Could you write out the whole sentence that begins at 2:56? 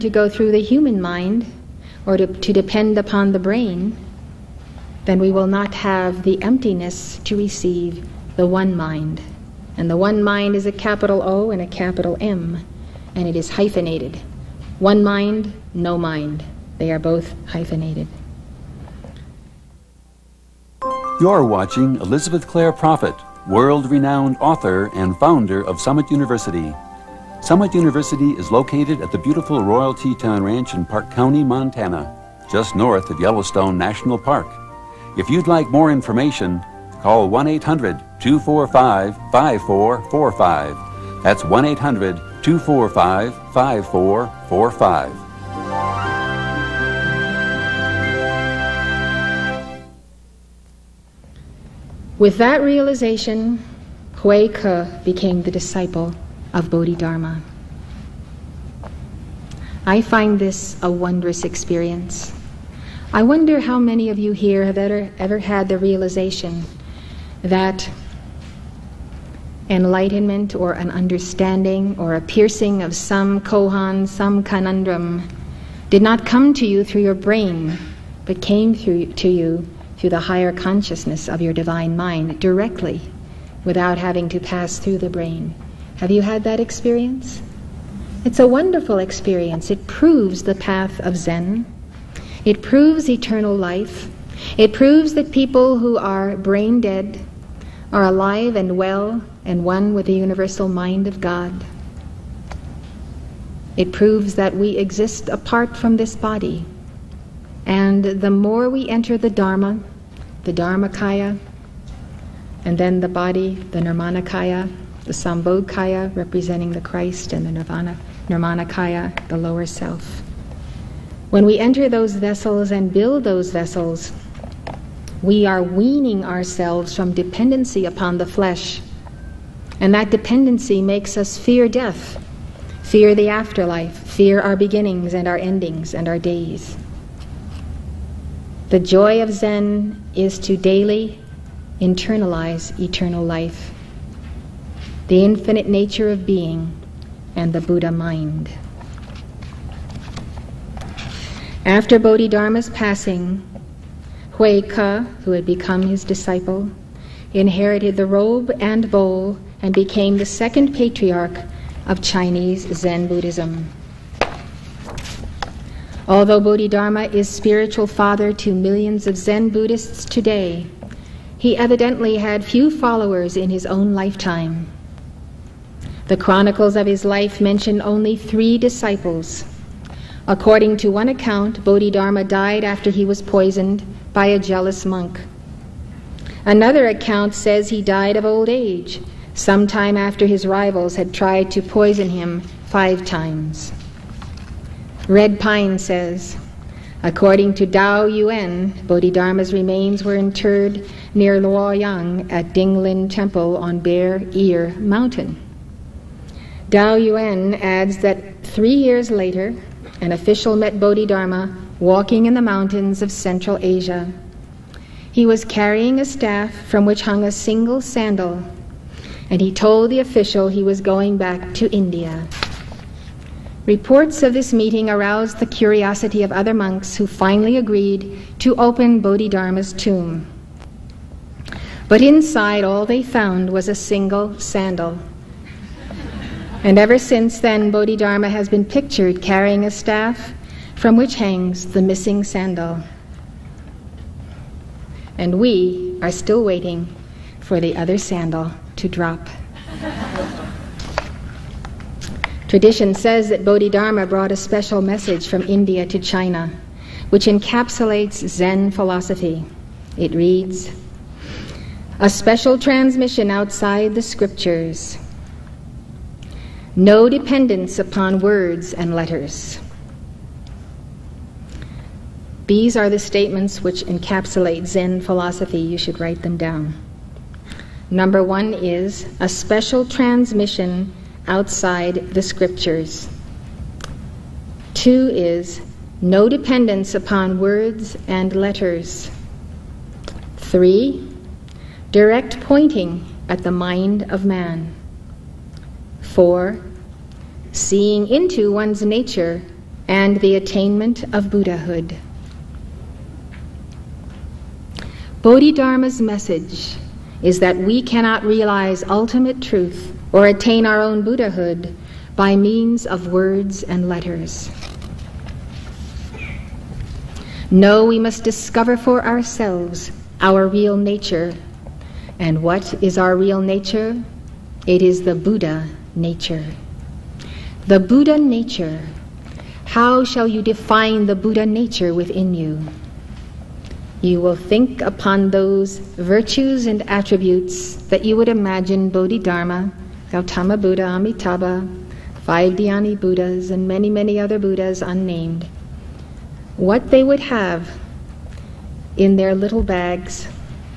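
The chronicles of his life mention only three disciples.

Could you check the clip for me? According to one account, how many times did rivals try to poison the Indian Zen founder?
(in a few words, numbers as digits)
5.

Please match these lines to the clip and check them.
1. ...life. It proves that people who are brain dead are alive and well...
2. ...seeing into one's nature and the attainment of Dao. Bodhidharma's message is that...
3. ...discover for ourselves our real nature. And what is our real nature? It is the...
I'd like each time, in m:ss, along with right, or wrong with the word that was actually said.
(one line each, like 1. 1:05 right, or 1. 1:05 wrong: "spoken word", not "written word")
1. 1:33 right
2. 4:57 wrong: "Buddhahood", not "Dao"
3. 5:18 right.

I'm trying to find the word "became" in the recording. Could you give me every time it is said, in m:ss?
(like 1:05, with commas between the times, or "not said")
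0:55, 2:39.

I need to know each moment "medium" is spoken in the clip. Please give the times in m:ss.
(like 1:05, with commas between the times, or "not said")
not said.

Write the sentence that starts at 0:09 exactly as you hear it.
And the one mind is a capital O and a capital M, and it is hyphenated.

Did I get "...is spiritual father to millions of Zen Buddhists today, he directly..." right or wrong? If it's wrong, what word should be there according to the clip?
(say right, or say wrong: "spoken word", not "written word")
wrong: "evidently", not "directly".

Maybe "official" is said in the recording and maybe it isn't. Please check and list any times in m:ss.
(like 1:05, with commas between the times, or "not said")
3:30, 3:39.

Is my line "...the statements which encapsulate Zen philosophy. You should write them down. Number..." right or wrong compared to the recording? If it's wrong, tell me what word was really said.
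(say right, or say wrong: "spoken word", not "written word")
right.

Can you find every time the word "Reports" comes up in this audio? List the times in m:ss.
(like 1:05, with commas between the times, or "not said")
3:43.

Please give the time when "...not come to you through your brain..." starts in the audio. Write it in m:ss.
1:16.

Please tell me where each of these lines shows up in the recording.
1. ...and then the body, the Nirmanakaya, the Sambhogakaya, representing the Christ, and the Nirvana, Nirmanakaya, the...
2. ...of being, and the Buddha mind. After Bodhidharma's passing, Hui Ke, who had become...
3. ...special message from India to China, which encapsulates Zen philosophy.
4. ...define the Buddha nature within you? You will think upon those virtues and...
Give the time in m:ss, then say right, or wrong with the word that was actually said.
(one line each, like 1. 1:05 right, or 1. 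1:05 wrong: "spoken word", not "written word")
1. 1:52 right
2. 2:26 right
3. 4:14 right
4. 5:30 right.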